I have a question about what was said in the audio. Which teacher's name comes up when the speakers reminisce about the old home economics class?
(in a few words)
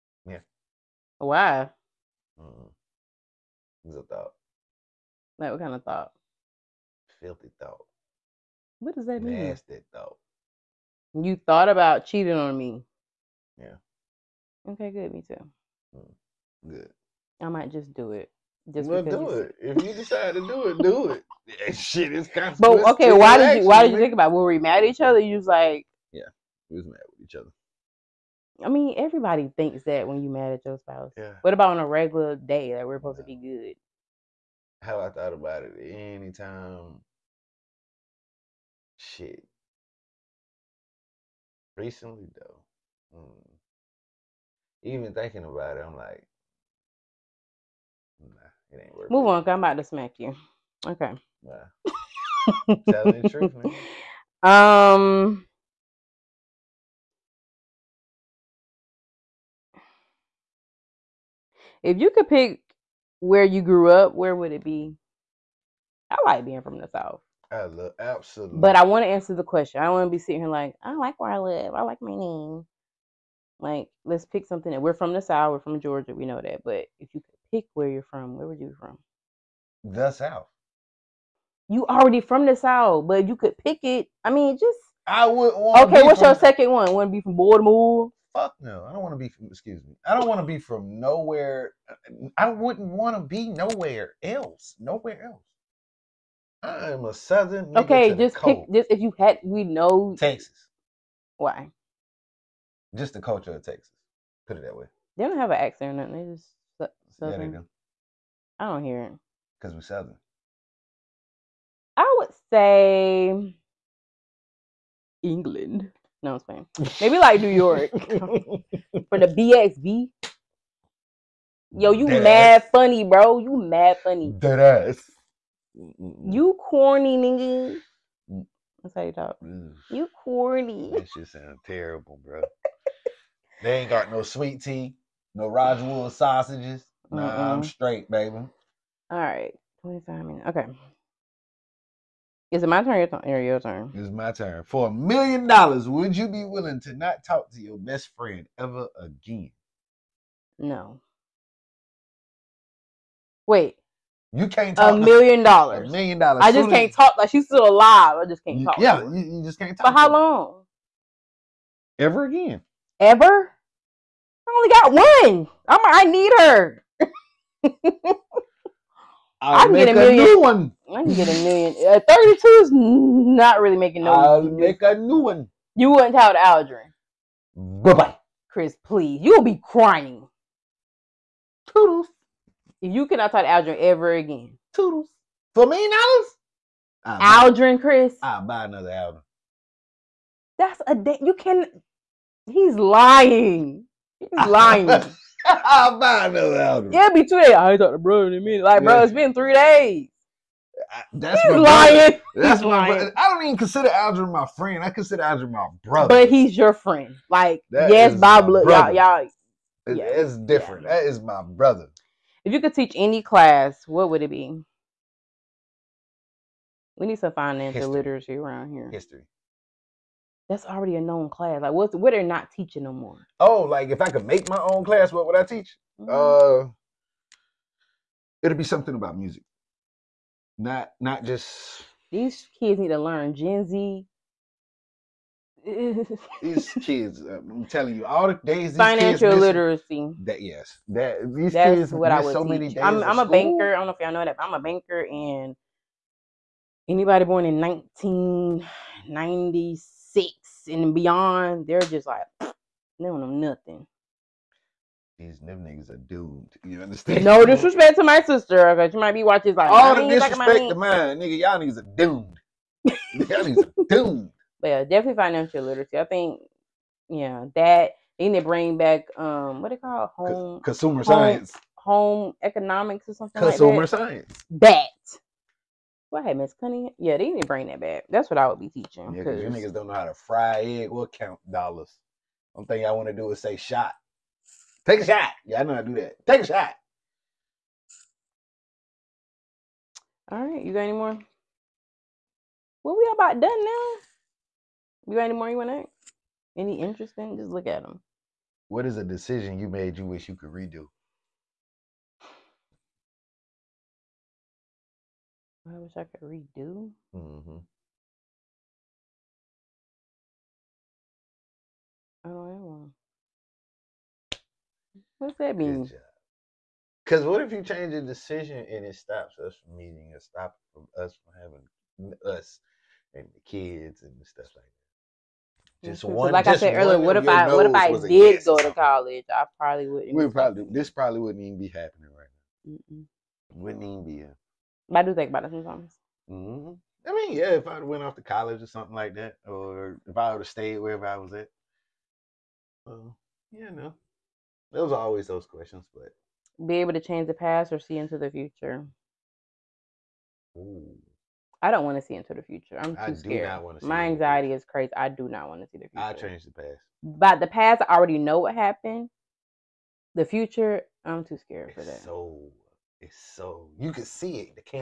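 Miss Cunningham.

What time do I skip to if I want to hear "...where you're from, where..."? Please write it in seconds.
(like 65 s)
77 s.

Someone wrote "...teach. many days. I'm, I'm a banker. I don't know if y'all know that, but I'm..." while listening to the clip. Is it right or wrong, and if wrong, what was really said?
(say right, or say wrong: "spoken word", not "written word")
right.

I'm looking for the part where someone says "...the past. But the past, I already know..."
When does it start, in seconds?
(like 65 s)
356 s.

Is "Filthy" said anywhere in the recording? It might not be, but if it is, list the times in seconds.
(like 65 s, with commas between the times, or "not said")
7 s.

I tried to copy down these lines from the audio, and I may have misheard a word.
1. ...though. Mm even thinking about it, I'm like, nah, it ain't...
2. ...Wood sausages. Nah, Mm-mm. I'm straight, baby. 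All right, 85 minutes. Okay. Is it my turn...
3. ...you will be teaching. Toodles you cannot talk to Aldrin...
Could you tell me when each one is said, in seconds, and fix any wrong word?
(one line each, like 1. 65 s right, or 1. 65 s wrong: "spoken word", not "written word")
1. 42 s right
2. 135 s wrong: "25", not "85"
3. 179 s wrong: "crying", not "teaching".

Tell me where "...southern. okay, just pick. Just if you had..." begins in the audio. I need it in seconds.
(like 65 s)
97 s.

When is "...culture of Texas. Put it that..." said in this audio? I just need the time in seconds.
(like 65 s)
103 s.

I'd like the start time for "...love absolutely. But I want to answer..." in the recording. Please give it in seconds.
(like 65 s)
67 s.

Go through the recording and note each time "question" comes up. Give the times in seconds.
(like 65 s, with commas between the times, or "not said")
69 s, 345 s.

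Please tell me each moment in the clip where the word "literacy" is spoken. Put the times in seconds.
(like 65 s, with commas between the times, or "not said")
217 s, 239 s, 265 s.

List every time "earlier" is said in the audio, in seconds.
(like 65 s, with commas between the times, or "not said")
326 s.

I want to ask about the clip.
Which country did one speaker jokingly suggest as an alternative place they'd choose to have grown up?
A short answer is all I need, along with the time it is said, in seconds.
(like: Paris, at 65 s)
England, at 115 s.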